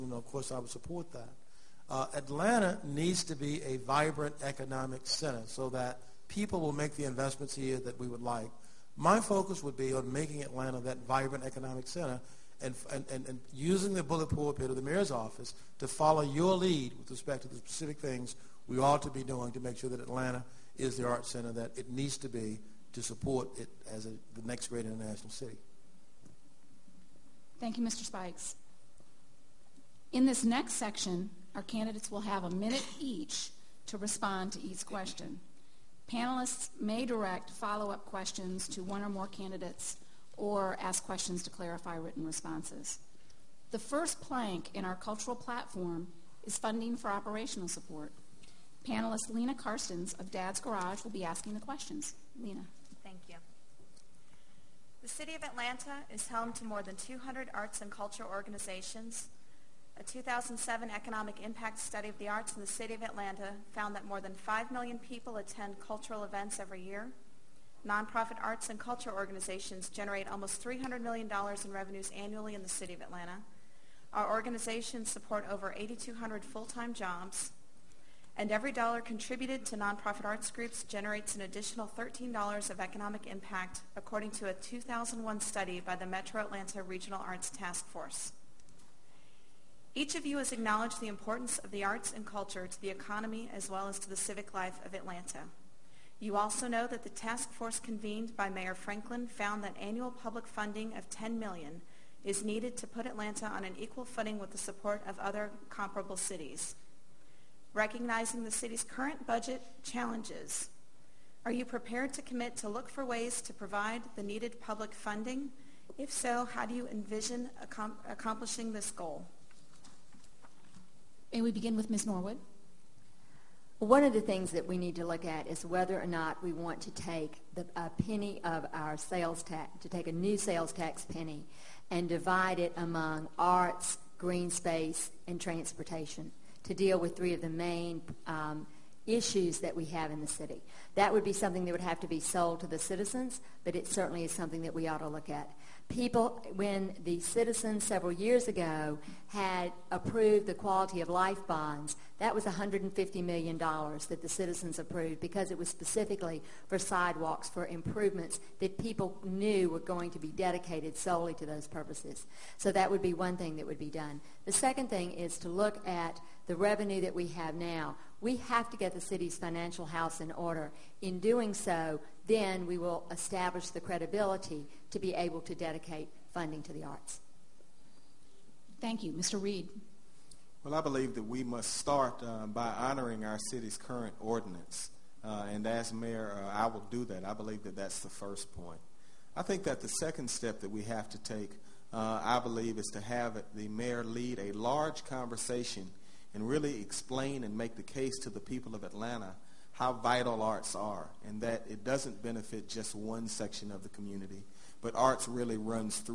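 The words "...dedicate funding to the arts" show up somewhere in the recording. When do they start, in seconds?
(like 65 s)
175 s.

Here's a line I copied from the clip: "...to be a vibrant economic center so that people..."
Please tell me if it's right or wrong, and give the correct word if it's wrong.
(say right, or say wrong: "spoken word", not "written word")
right.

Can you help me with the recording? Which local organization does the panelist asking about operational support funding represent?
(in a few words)
Dad's Garage.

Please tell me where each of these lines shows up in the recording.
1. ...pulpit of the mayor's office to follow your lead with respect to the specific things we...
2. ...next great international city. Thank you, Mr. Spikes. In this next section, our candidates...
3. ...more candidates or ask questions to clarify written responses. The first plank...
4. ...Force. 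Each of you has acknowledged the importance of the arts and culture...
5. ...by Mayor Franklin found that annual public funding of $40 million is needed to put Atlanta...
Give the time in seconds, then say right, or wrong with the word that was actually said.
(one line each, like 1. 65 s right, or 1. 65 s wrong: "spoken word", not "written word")
1. 14 s right
2. 24 s right
3. 39 s right
4. 87 s right
5. 98 s wrong: "10", not "40".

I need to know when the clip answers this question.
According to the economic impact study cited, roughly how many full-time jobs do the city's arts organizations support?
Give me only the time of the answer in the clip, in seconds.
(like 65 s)
75 s.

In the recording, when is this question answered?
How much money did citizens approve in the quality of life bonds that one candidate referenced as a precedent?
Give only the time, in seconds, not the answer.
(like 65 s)
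152 s.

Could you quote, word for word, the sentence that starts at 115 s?
If so, how do you envision accomplishing this goal?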